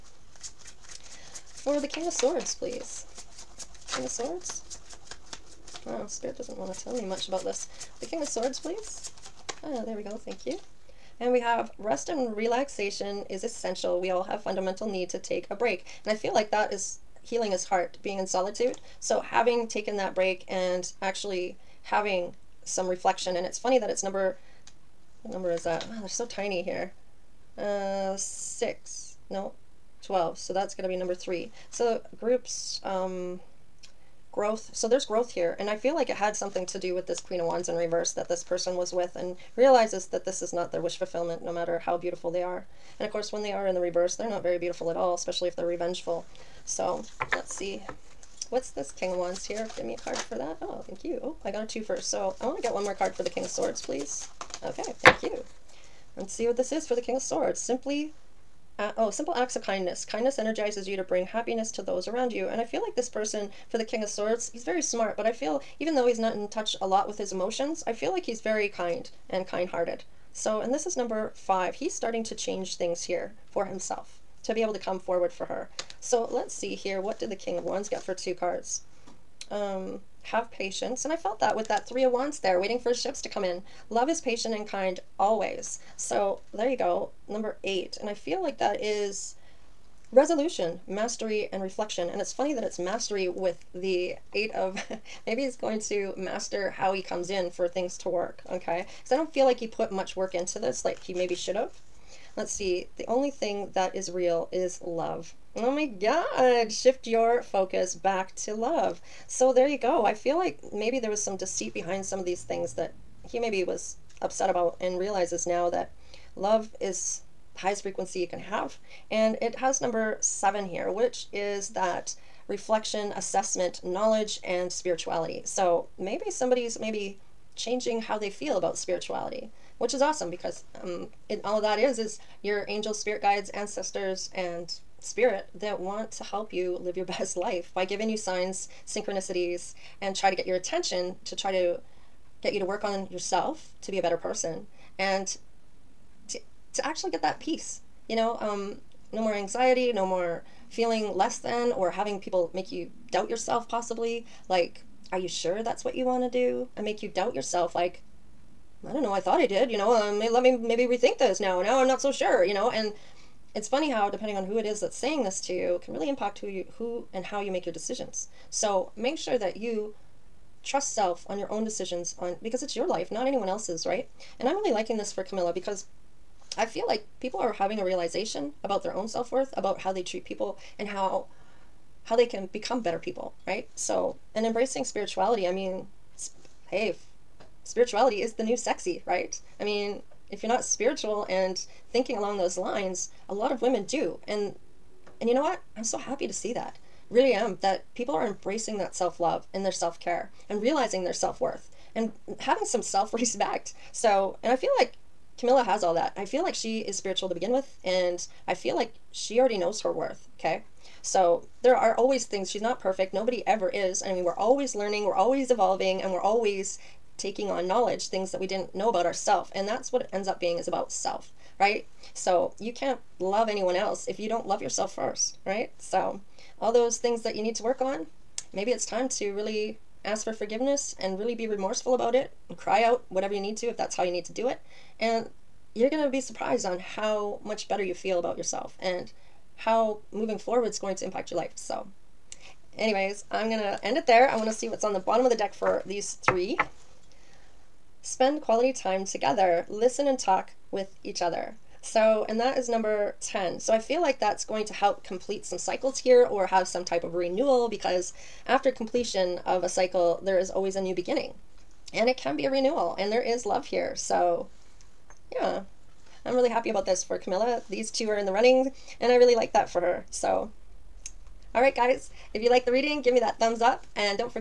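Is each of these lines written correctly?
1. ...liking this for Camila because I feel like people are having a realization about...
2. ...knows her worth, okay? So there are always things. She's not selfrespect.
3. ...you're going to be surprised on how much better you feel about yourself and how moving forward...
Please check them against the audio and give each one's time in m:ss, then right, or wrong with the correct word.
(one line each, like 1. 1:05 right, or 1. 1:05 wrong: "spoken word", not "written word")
1. 2:54 right
2. 3:29 wrong: "perfect", not "selfrespect"
3. 3:55 right.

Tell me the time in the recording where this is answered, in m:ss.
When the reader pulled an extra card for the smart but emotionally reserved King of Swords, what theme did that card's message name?
0:59.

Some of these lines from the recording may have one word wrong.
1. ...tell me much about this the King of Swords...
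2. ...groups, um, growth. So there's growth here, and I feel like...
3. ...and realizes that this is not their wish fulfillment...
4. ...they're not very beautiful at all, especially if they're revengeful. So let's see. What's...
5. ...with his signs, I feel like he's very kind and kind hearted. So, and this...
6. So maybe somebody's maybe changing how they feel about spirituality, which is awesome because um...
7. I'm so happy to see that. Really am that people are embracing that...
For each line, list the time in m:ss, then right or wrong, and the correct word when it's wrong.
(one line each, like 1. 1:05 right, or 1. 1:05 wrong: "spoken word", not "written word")
1. 0:06 right
2. 0:32 right
3. 0:39 right
4. 0:44 right
5. 1:07 wrong: "emotions", not "signs"
6. 2:05 right
7. 3:15 right.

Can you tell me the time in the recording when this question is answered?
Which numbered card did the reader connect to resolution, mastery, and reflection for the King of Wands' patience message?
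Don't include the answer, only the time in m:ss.
1:27.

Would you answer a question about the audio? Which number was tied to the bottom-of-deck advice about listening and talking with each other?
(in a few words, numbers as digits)
10.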